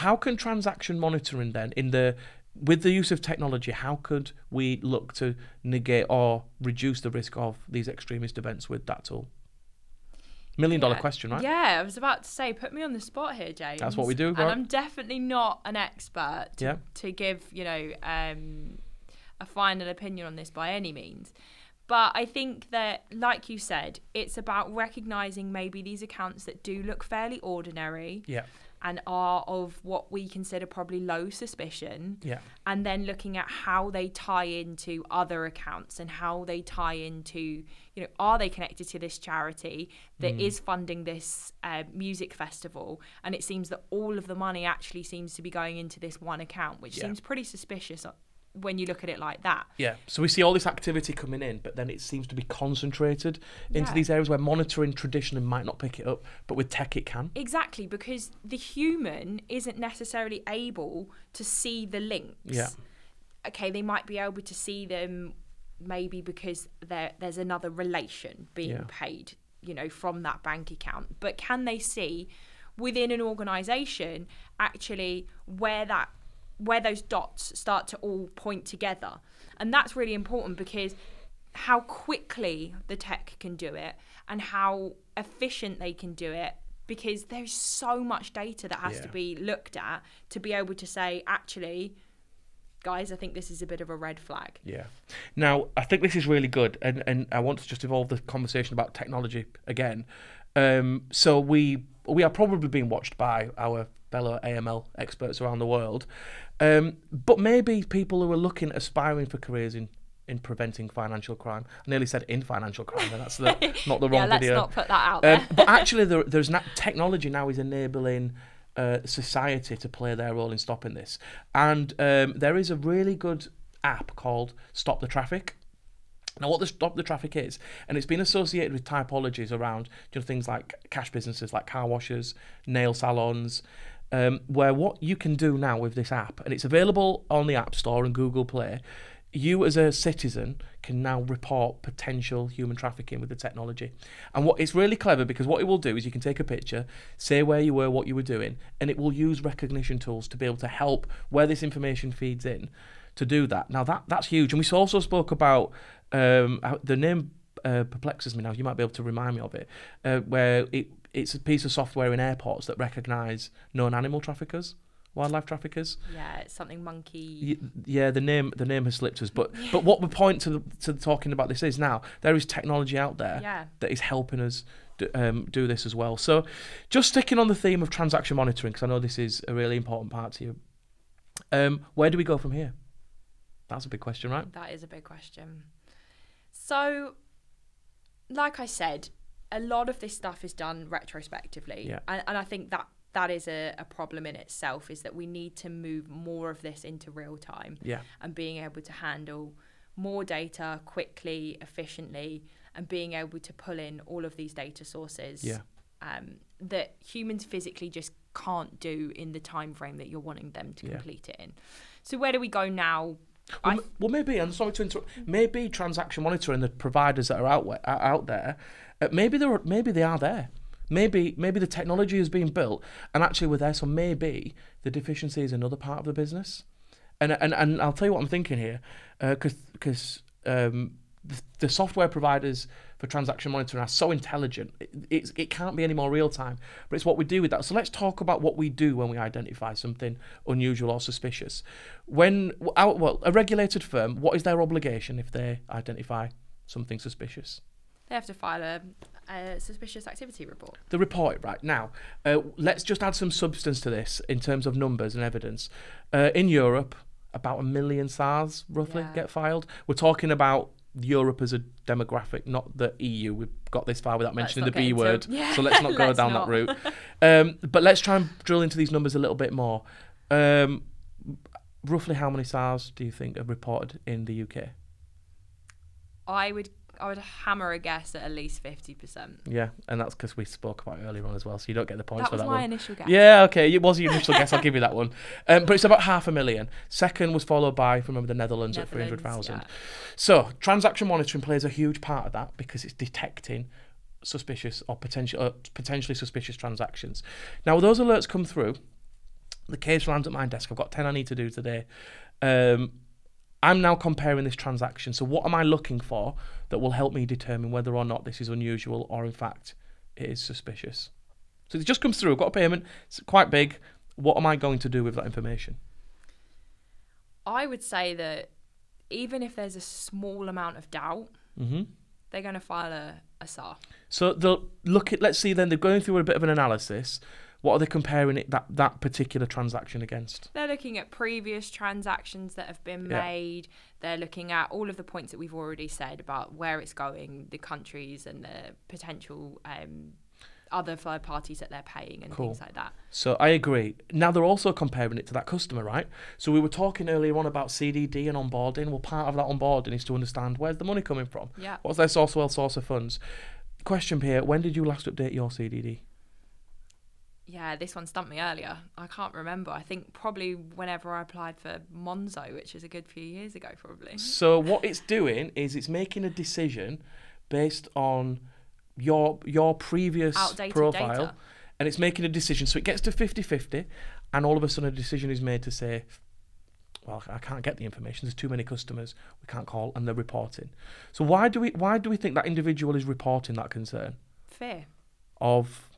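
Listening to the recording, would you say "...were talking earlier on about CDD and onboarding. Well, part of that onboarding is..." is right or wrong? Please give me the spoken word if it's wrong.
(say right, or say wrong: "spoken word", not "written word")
right.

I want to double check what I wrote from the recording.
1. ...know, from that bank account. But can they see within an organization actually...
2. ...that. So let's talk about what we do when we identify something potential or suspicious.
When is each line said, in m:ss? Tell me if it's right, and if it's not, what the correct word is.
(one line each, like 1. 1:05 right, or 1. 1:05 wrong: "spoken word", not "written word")
1. 1:09 right
2. 3:57 wrong: "unusual", not "potential".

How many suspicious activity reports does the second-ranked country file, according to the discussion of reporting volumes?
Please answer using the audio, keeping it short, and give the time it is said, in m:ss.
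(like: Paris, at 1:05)
300,000, at 4:48.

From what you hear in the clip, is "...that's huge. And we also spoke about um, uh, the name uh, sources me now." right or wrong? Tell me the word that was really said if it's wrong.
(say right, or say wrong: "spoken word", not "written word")
wrong: "perplexes", not "sources".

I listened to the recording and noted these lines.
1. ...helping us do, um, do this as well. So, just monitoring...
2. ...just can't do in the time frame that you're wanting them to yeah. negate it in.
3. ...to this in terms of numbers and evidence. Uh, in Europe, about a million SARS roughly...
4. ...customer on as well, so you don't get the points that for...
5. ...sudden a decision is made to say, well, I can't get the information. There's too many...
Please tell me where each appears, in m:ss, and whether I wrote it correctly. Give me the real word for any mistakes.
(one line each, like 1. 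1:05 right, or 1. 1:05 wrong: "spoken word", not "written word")
1. 2:53 wrong: "sticking", not "monitoring"
2. 3:27 wrong: "complete", not "negate"
3. 4:13 right
4. 4:41 wrong: "earlier", not "customer"
5. 6:14 right.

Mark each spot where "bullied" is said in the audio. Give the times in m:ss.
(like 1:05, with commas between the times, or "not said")
not said.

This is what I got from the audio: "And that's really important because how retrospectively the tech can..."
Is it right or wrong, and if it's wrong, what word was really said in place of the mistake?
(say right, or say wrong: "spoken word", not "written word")
wrong: "quickly", not "retrospectively".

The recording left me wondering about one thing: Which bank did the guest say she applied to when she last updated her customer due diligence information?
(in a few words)
Monzo.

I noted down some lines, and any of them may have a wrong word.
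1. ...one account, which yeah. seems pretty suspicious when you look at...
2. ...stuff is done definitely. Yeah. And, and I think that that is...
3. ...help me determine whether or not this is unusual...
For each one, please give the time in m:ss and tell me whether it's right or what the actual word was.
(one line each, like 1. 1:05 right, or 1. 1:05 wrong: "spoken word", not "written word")
1. 0:46 right
2. 3:10 wrong: "retrospectively", not "definitely"
3. 5:06 right.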